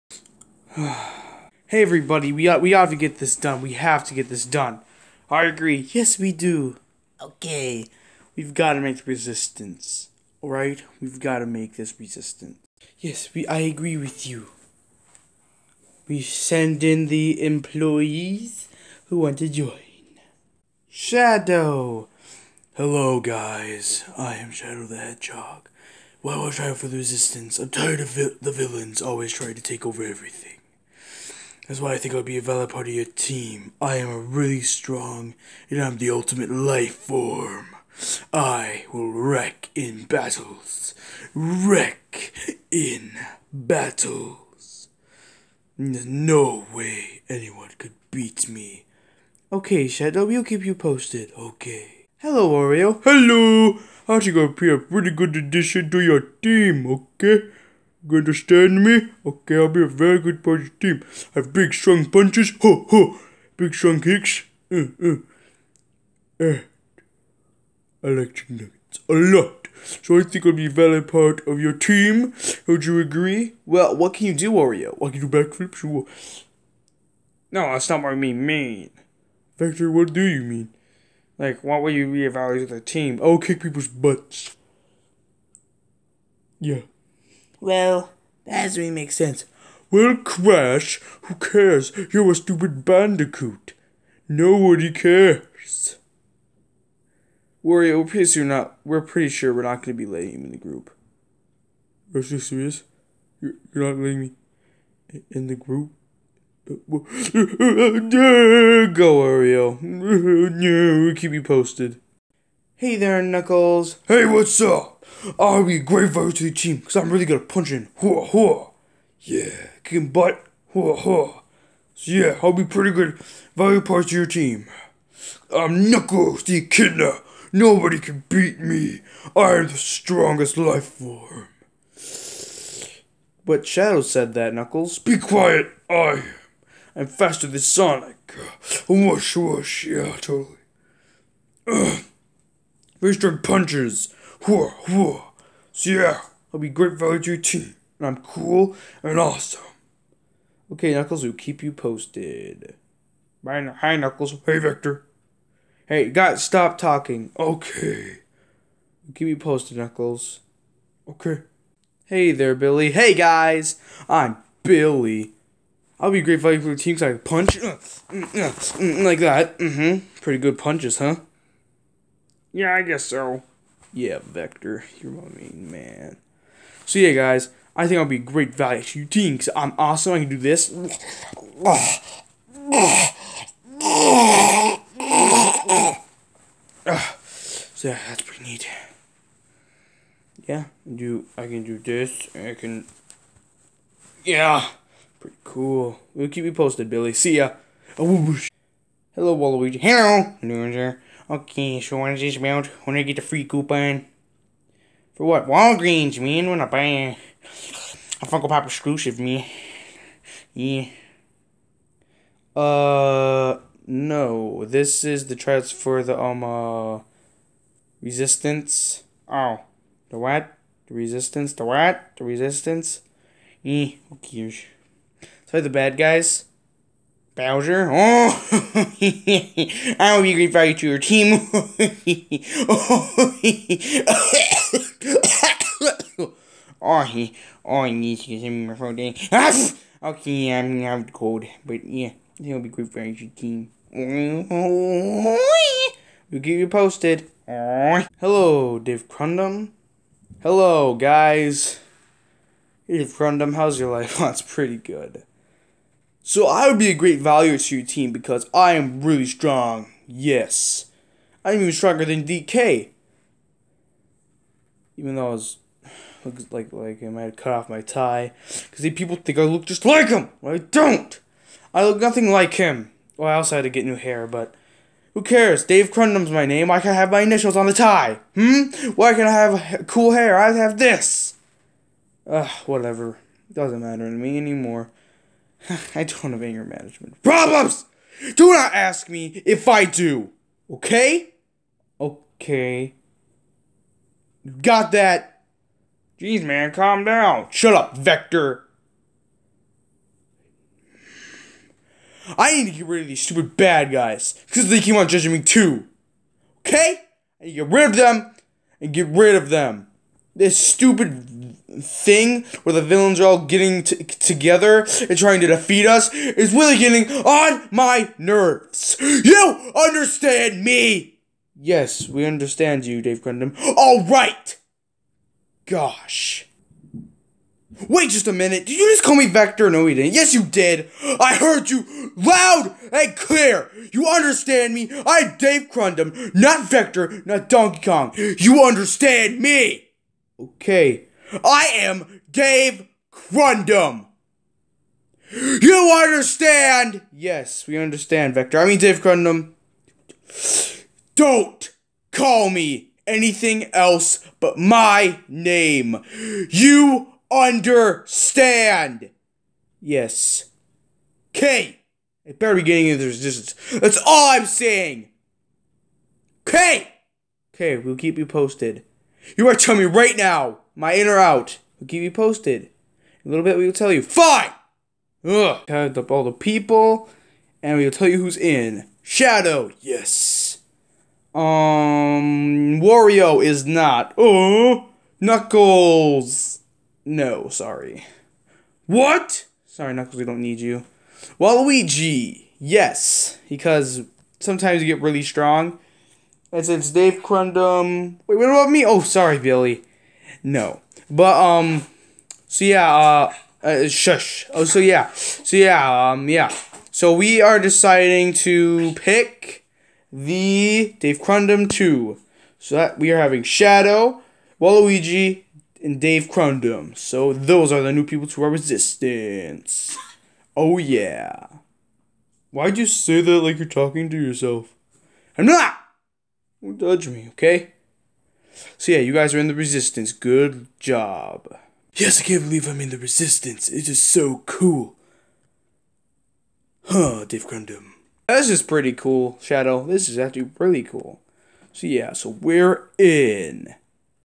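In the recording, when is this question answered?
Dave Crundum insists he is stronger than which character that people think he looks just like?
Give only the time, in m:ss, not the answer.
4:22.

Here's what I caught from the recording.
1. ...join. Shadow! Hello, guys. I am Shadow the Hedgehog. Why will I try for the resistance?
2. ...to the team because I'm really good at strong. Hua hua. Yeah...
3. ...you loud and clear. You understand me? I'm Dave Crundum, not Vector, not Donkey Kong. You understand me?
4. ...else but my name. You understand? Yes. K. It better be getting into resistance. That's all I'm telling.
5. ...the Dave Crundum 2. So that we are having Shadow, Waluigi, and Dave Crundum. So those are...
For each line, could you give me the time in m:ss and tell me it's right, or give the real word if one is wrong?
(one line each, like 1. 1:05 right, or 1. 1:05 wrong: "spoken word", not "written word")
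1. 0:19 right
2. 1:56 wrong: "punching", not "strong"
3. 5:31 right
4. 5:53 wrong: "saying", not "telling"
5. 6:50 right.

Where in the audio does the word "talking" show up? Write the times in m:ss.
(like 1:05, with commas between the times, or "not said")
2:36, 7:03.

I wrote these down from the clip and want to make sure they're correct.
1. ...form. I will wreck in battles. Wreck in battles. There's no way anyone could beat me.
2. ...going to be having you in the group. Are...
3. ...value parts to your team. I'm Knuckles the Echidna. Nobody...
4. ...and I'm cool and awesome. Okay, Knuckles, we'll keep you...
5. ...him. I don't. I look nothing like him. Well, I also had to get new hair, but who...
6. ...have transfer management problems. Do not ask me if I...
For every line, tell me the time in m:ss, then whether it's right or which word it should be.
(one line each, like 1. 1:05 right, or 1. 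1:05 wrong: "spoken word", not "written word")
1. 0:36 right
2. 1:39 wrong: "letting", not "having"
3. 2:03 right
4. 2:27 right
5. 4:30 right
6. 4:46 wrong: "anger", not "transfer".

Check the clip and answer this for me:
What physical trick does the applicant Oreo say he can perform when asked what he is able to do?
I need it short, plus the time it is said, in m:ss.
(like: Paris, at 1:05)
Backflips, at 1:15.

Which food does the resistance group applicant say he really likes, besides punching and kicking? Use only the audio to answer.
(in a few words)
Chicken nuggets.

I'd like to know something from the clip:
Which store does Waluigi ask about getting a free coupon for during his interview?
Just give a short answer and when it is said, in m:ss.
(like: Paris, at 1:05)
Walgreens, at 3:25.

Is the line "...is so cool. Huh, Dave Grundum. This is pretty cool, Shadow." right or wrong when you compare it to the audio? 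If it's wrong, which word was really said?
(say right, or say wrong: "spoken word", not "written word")
right.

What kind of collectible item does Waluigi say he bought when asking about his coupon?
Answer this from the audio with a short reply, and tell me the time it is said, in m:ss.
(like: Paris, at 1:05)
Funko Pop exclusive, at 3:28.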